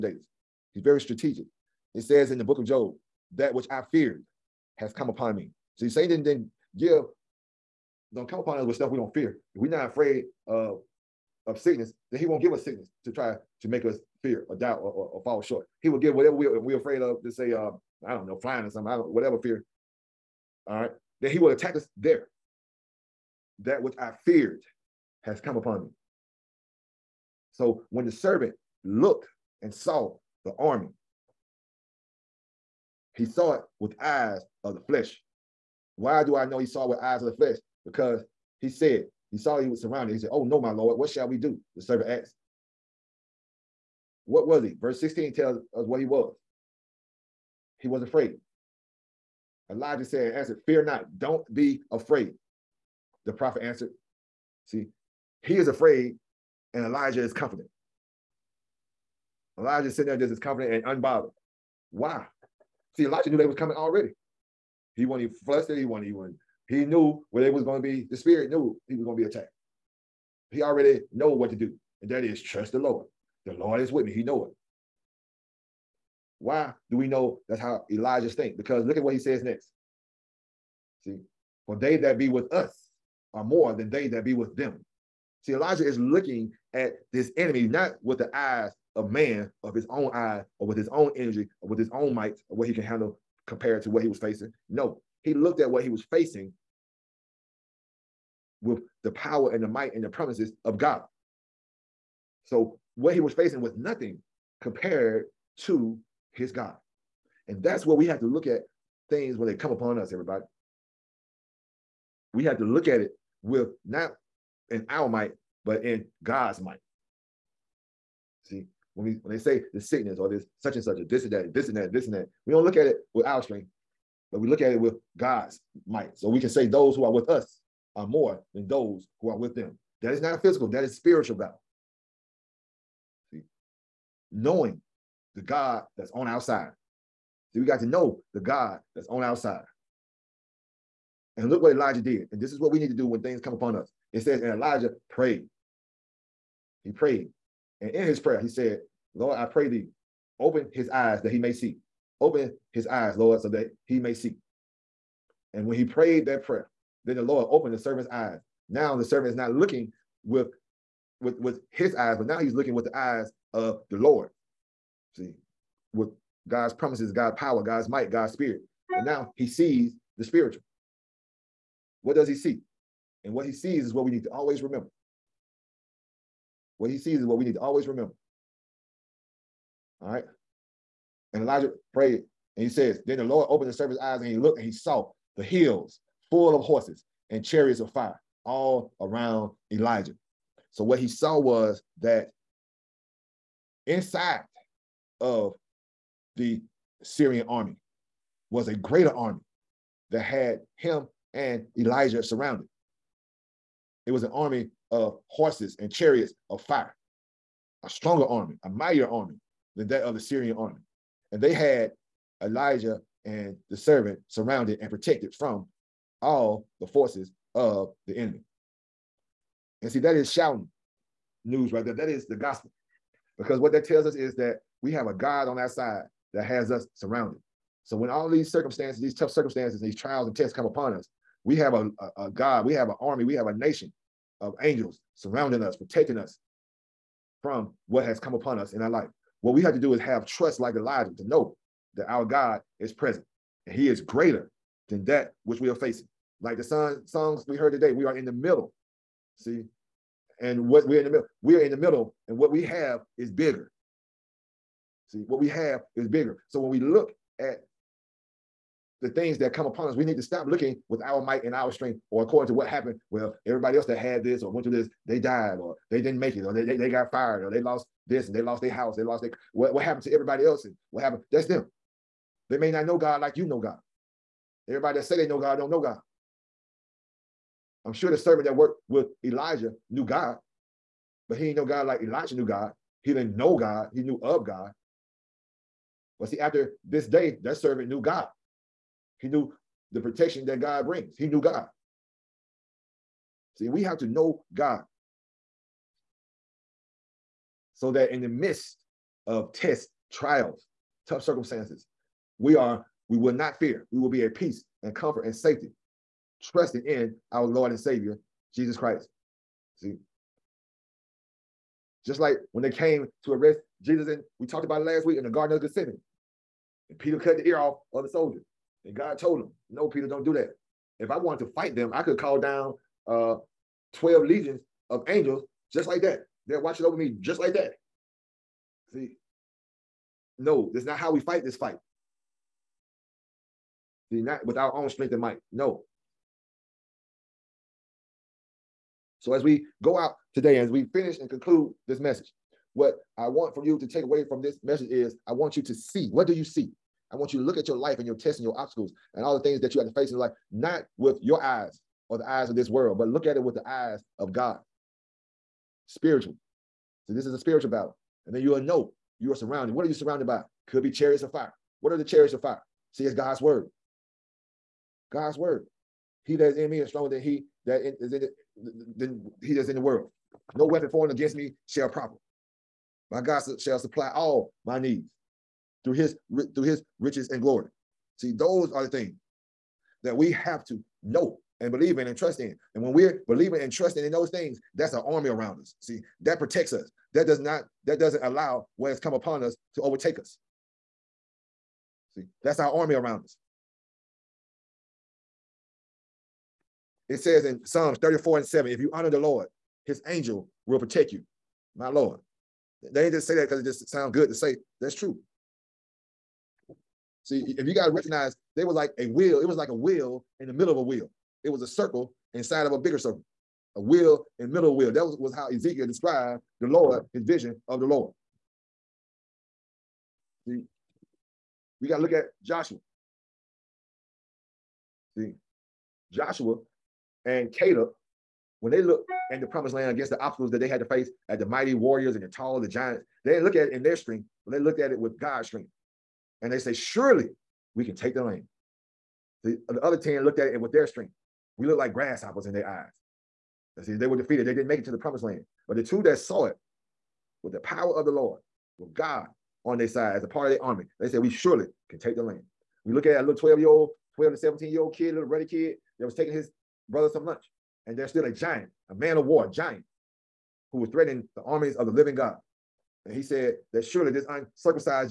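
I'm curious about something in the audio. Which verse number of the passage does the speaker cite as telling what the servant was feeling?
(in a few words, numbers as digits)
16.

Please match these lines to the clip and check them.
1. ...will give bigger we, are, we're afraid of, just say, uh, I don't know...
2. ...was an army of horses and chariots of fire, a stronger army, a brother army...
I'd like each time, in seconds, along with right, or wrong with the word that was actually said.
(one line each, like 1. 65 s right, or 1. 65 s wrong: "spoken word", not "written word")
1. 15 s wrong: "whatever", not "bigger"
2. 204 s wrong: "mightier", not "brother".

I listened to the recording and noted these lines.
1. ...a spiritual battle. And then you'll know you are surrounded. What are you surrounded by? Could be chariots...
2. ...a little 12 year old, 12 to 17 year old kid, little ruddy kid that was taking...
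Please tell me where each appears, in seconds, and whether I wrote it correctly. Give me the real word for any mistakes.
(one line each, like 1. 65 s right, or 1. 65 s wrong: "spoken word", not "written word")
1. 357 s right
2. 453 s right.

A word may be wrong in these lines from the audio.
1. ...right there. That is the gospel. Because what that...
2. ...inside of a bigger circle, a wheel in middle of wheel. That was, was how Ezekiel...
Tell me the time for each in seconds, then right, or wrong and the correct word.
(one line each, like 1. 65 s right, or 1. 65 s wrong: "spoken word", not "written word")
1. 221 s right
2. 412 s right.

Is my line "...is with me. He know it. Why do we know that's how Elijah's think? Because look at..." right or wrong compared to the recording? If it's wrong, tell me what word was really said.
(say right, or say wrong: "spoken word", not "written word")
right.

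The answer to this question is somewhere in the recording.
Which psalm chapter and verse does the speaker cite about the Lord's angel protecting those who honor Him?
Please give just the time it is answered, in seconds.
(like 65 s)
397 s.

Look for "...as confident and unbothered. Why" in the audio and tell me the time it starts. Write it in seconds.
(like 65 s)
60 s.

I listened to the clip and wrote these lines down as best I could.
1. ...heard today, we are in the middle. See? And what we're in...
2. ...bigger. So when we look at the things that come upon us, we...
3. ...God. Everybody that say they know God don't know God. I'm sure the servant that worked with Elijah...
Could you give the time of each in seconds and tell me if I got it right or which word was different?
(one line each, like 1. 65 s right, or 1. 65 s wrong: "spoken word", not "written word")
1. 247 s right
2. 256 s right
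3. 273 s right.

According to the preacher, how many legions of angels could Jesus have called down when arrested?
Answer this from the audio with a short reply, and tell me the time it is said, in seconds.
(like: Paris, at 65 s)
12, at 323 s.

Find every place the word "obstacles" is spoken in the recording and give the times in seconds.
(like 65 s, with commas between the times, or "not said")
348 s, 430 s.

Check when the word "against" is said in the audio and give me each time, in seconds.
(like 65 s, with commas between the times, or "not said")
371 s, 429 s.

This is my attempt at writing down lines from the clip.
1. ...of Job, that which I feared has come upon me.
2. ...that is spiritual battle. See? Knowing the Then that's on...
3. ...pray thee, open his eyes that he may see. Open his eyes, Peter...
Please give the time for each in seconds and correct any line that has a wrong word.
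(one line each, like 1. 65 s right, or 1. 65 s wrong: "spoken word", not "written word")
1. 2 s right
2. 130 s wrong: "God", not "Then"
3. 149 s wrong: "Lord", not "Peter".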